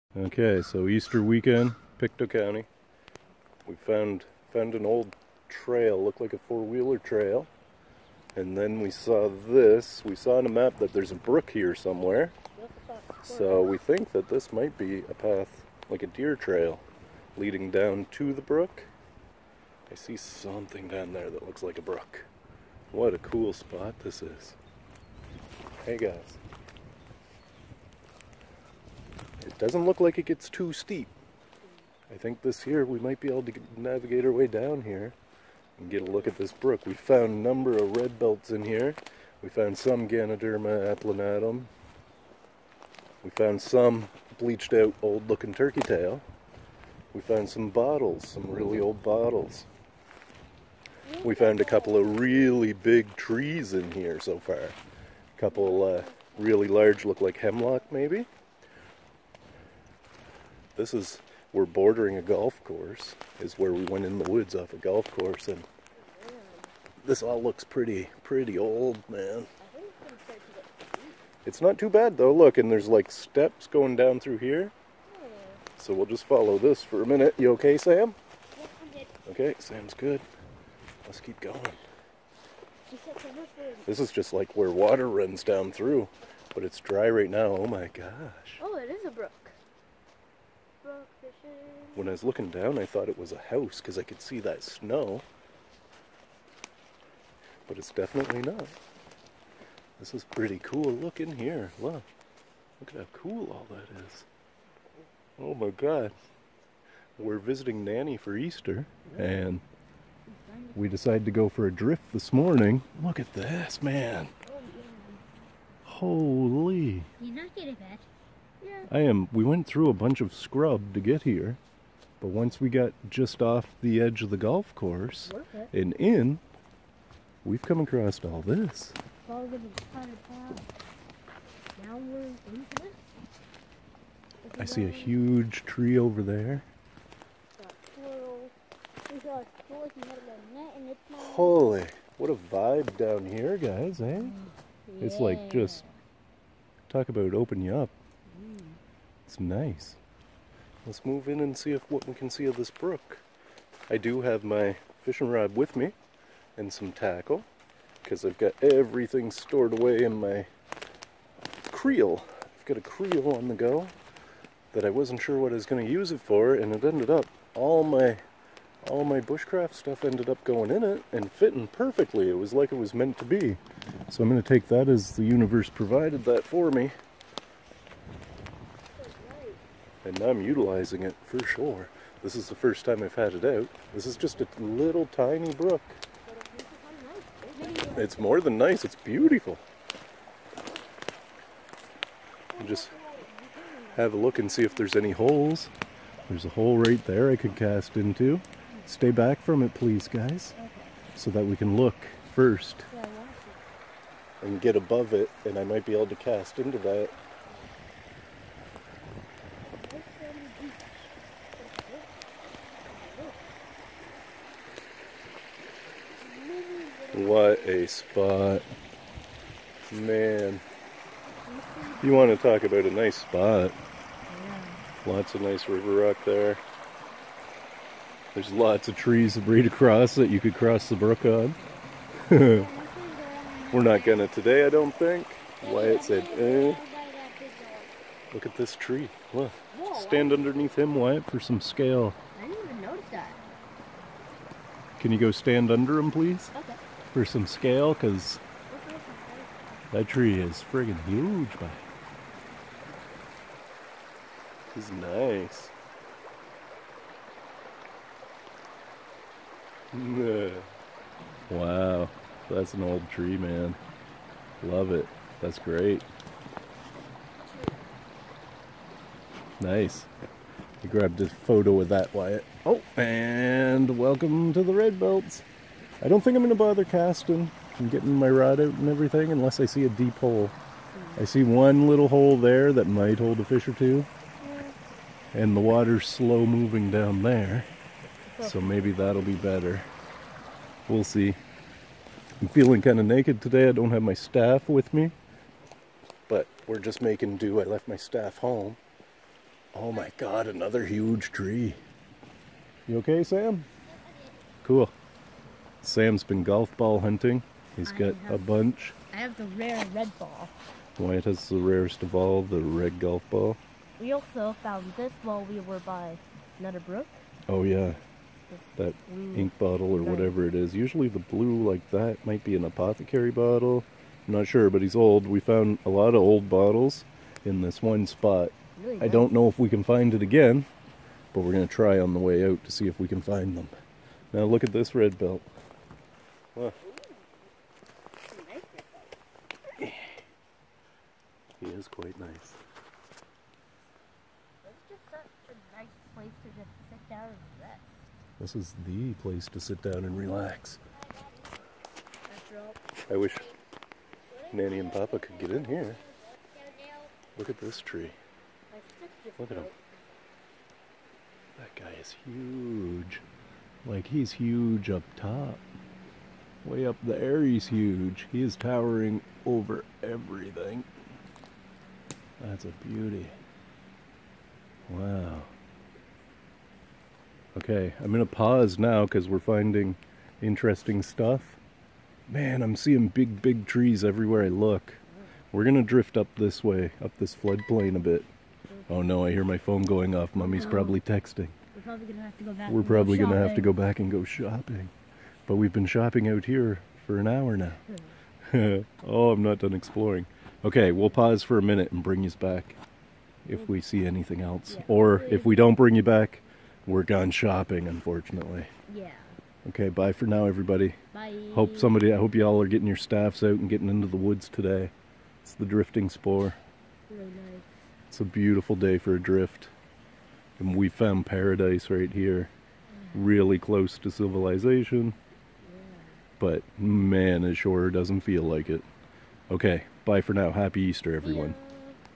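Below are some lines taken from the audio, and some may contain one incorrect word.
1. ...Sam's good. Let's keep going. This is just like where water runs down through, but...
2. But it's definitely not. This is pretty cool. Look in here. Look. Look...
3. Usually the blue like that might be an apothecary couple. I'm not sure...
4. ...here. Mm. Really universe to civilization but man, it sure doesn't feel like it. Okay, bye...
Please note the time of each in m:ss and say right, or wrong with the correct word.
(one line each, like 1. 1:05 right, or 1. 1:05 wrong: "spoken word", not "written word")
1. 1:19 right
2. 1:37 right
3. 5:20 wrong: "bottle", not "couple"
4. 7:02 wrong: "close", not "universe".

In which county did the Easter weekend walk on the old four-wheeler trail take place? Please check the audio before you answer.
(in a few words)
Pictou County.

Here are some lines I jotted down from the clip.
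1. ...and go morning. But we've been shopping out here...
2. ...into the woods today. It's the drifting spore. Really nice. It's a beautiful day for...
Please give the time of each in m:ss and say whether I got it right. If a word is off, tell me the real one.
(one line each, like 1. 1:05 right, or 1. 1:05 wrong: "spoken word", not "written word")
1. 6:33 wrong: "shopping", not "morning"
2. 6:53 right.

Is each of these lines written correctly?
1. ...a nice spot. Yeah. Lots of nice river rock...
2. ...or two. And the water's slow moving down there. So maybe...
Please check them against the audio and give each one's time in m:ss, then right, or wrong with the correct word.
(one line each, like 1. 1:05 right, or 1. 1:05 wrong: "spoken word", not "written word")
1. 3:42 right
2. 4:43 right.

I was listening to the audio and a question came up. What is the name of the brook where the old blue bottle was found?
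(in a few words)
Nutter Brook.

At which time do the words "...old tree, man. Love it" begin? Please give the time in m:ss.
4:22.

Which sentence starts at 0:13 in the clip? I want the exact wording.
So we think that this might be a path, like a deer trail, leading down to the brook.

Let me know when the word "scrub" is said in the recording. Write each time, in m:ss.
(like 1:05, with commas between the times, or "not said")
2:00.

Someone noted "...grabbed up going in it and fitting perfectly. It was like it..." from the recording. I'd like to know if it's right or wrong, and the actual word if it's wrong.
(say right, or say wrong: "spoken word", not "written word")
wrong: "ended", not "grabbed".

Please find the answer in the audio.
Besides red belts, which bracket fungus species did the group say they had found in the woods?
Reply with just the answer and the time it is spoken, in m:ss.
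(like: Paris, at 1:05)
Ganoderma applanatum, at 0:40.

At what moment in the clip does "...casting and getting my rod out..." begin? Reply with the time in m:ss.
4:36.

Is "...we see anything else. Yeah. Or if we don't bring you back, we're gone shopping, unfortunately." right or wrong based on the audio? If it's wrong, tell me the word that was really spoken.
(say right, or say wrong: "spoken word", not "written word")
right.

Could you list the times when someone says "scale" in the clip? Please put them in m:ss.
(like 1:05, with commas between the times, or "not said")
4:01, 4:07.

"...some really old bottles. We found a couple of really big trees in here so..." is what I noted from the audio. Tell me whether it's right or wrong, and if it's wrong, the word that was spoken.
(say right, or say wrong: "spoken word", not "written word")
right.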